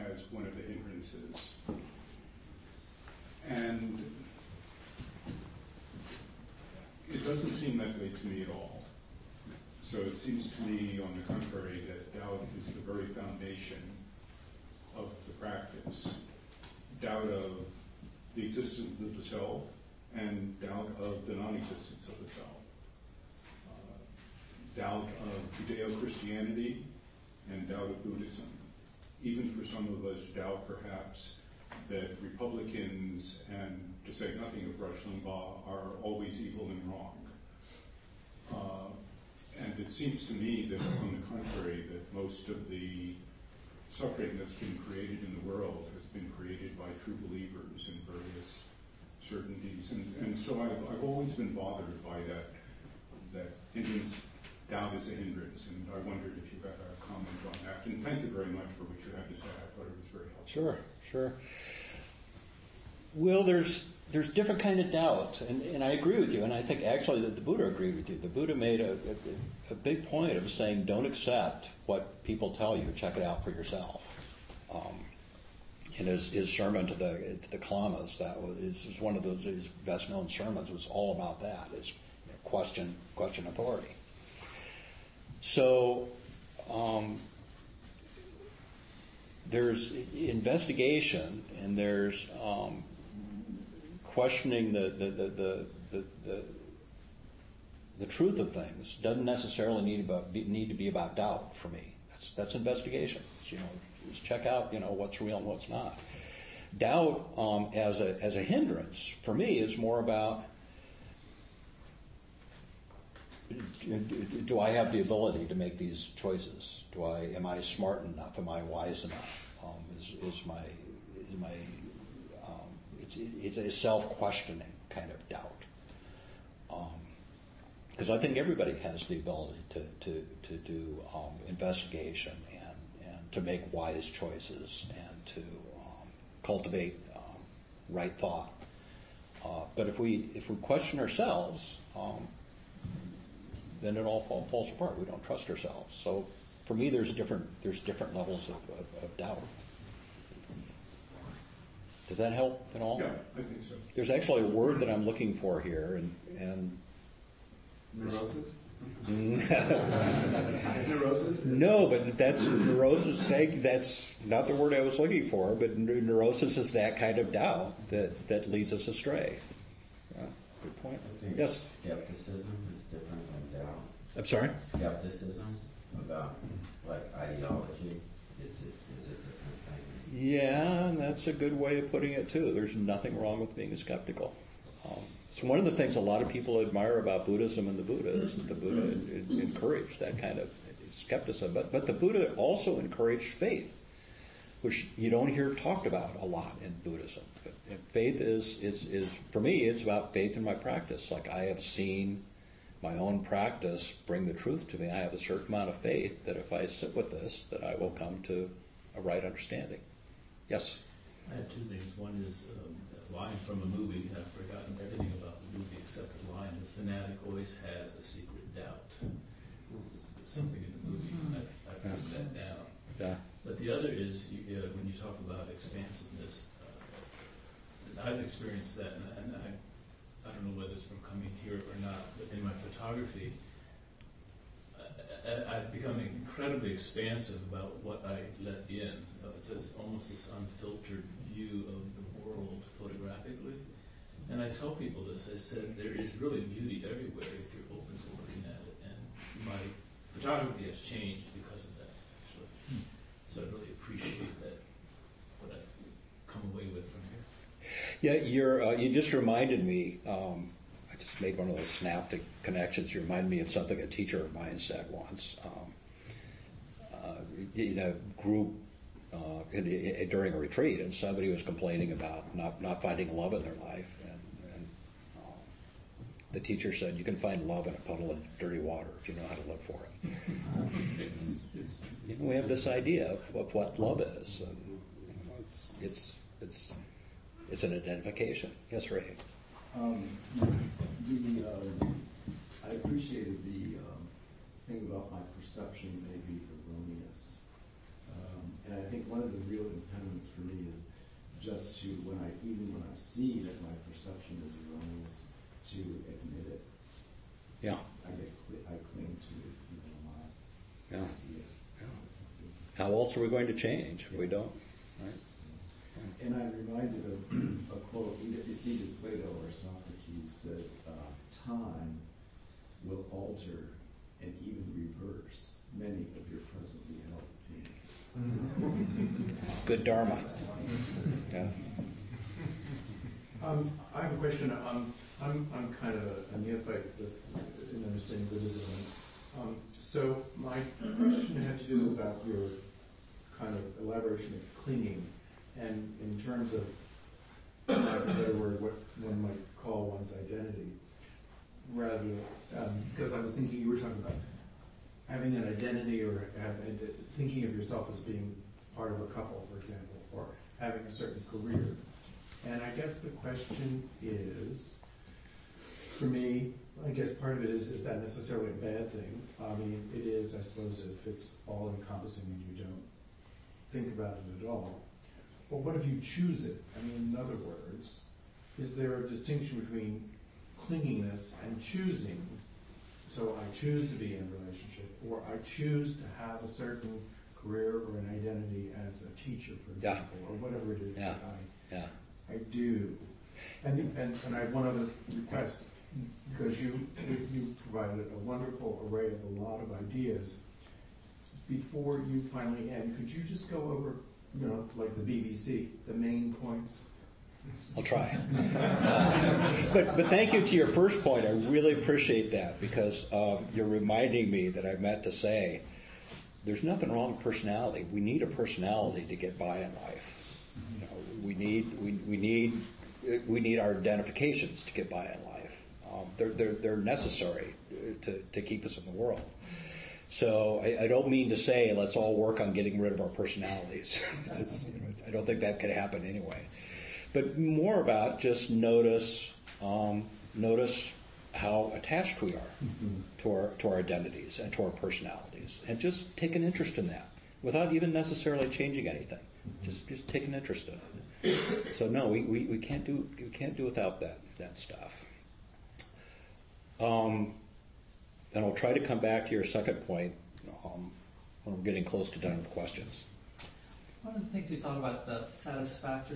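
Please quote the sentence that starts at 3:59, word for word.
It's almost this unfiltered view of the world photographed and I tell people this.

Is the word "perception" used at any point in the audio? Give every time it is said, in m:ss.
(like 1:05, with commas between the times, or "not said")
4:55, 5:03.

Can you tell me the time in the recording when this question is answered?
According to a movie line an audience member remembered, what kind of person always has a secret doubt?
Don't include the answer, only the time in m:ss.
3:36.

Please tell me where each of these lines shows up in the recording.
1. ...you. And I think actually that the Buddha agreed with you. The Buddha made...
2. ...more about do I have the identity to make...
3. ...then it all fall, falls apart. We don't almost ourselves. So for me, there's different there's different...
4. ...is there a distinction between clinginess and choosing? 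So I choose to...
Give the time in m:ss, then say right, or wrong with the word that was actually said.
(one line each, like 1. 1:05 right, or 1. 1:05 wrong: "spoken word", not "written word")
1. 1:06 right
2. 1:49 wrong: "ability", not "identity"
3. 2:23 wrong: "trust", not "almost"
4. 6:18 right.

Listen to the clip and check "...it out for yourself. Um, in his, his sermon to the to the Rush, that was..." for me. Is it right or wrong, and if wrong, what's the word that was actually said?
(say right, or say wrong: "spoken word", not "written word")
wrong: "Kalamas", not "Rush".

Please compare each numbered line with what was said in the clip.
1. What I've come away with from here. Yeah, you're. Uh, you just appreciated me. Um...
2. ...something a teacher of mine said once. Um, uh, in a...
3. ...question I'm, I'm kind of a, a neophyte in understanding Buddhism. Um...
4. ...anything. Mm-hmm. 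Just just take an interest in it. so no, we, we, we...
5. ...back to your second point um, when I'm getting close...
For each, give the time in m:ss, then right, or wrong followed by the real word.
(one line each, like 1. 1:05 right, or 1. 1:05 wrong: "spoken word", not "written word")
1. 4:15 wrong: "reminded", not "appreciated"
2. 4:23 right
3. 5:34 right
4. 7:28 right
5. 7:38 right.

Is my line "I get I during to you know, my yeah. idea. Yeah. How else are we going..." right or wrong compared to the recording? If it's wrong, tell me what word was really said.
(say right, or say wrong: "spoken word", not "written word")
wrong: "cling", not "during".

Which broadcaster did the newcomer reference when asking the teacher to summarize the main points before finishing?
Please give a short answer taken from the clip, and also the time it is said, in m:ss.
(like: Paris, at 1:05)
BBC, at 6:45.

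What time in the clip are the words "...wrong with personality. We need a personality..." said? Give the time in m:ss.
6:56.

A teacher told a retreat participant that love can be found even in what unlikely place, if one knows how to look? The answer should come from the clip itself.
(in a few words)
A puddle of dirty water.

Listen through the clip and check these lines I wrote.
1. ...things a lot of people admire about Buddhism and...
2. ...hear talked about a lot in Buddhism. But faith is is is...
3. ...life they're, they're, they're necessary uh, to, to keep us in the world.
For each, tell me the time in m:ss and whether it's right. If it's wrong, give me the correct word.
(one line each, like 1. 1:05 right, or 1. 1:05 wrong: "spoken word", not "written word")
1. 3:05 right
2. 3:15 right
3. 7:05 right.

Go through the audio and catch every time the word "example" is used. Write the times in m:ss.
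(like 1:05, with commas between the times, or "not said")
5:59, 6:29.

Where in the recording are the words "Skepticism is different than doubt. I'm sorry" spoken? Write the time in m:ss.
2:51.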